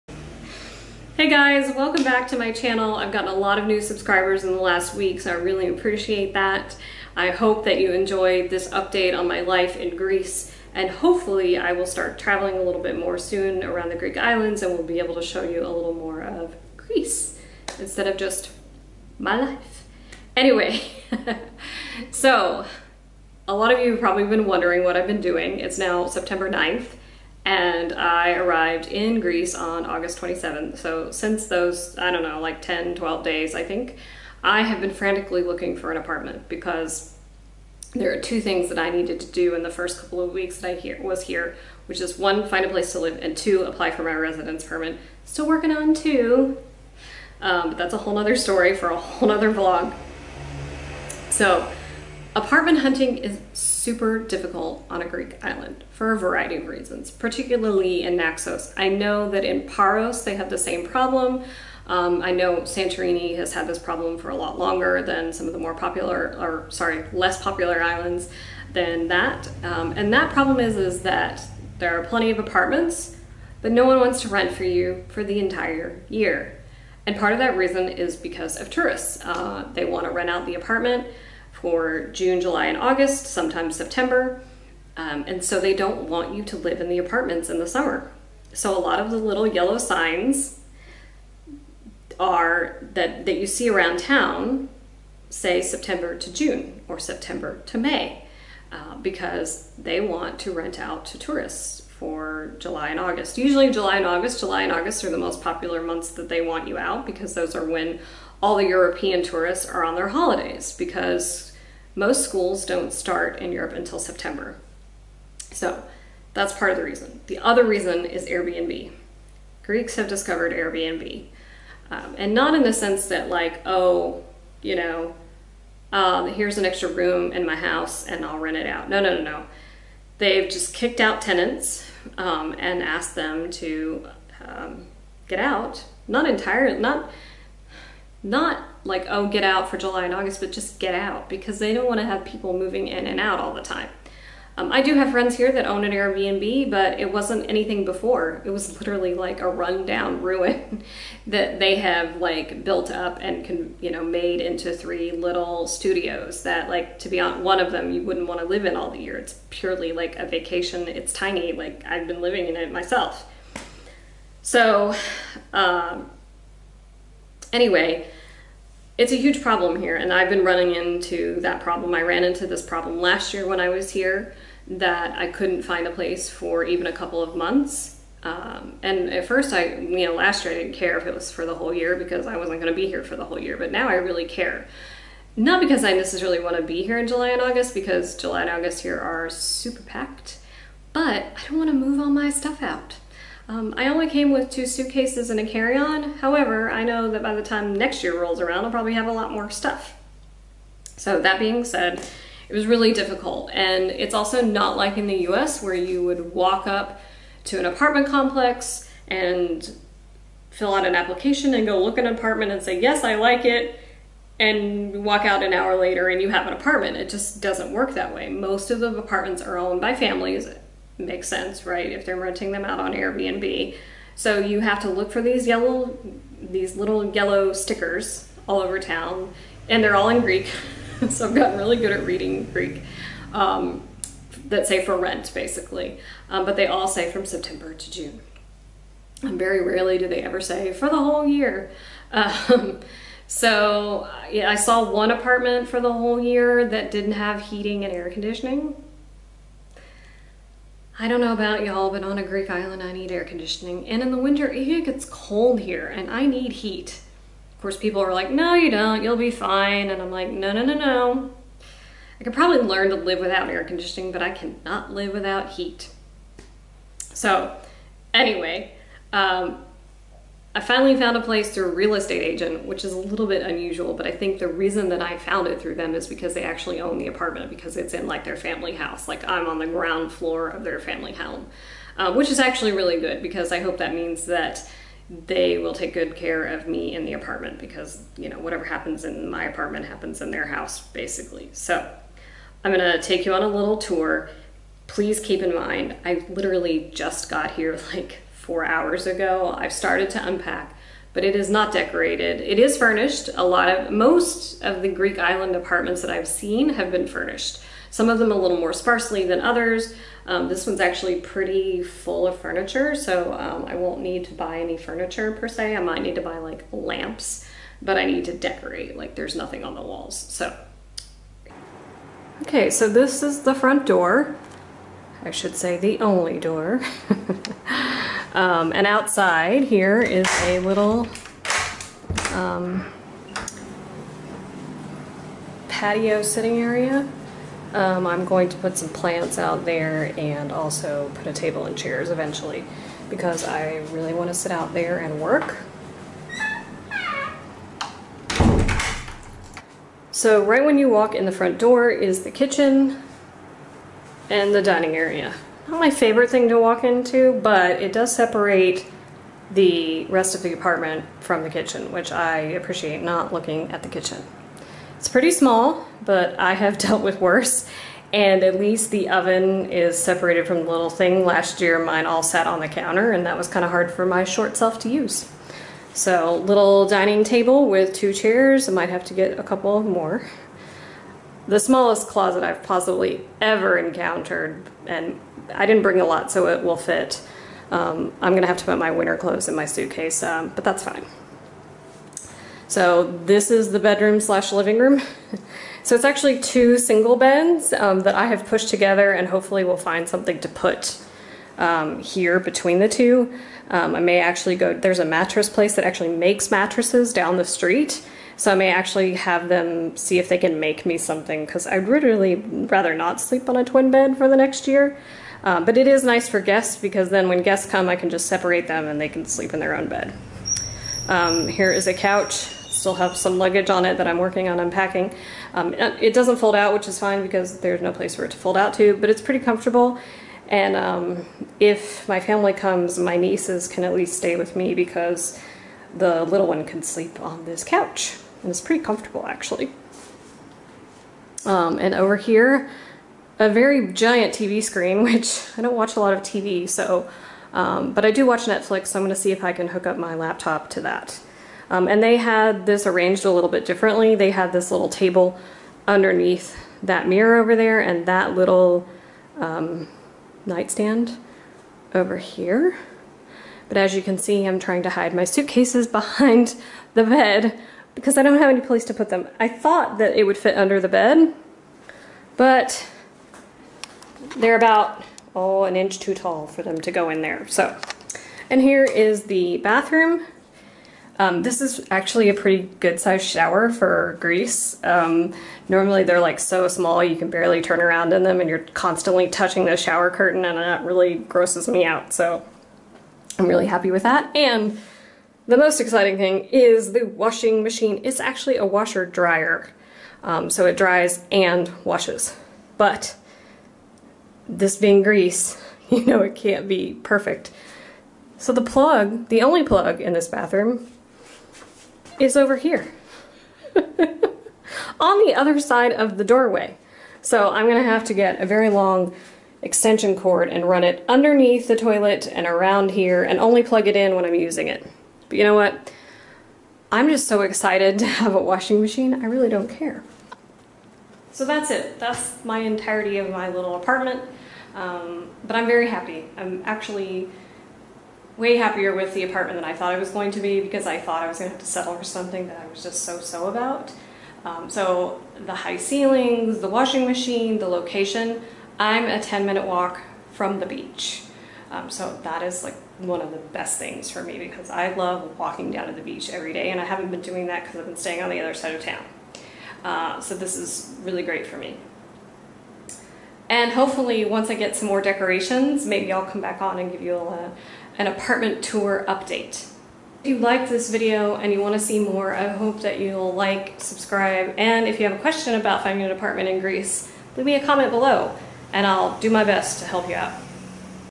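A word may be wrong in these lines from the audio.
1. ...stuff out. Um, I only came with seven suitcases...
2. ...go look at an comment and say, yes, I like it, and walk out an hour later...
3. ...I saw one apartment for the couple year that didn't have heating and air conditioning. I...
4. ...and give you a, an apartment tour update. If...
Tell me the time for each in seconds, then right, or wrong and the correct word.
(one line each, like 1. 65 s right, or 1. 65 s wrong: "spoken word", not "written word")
1. 192 s wrong: "two", not "seven"
2. 211 s wrong: "apartment", not "comment"
3. 244 s wrong: "whole", not "couple"
4. 566 s right.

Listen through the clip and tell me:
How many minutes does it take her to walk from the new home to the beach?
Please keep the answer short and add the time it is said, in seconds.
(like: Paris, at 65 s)
10, at 549 s.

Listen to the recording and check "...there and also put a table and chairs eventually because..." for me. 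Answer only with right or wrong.
right.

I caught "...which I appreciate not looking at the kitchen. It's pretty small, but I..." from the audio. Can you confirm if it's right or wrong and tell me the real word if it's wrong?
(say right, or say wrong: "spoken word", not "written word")
right.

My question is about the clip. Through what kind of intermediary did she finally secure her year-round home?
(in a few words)
A real estate agent.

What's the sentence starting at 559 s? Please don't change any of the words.
Uh, so this is really great for me.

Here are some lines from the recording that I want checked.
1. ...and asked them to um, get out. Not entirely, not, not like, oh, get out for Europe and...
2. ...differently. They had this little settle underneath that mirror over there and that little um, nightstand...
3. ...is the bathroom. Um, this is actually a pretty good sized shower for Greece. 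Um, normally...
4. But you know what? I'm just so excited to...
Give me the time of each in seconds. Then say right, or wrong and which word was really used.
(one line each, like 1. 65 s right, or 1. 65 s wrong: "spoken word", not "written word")
1. 132 s wrong: "July", not "Europe"
2. 453 s wrong: "table", not "settle"
3. 478 s right
4. 525 s right.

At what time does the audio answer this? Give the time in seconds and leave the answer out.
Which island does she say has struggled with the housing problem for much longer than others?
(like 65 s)
62 s.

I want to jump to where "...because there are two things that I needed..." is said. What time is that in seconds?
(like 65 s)
36 s.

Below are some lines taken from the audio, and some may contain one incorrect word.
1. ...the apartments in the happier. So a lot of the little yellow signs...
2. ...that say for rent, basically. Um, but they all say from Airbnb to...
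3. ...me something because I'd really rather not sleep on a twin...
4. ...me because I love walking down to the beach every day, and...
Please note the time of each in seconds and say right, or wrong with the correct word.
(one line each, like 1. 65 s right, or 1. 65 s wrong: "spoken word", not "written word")
1. 86 s wrong: "summer", not "happier"
2. 234 s wrong: "September", not "Airbnb"
3. 410 s right
4. 554 s right.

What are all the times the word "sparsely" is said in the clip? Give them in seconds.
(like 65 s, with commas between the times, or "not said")
308 s.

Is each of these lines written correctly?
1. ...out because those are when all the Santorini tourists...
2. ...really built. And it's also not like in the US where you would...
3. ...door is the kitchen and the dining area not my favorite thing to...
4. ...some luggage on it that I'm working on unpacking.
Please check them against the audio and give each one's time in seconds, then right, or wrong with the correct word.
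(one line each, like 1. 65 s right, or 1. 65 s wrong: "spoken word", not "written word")
1. 106 s wrong: "European", not "Santorini"
2. 202 s wrong: "difficult", not "built"
3. 351 s right
4. 423 s right.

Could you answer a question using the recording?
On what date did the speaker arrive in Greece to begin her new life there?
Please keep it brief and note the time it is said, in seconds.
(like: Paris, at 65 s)
August 27th, at 29 s.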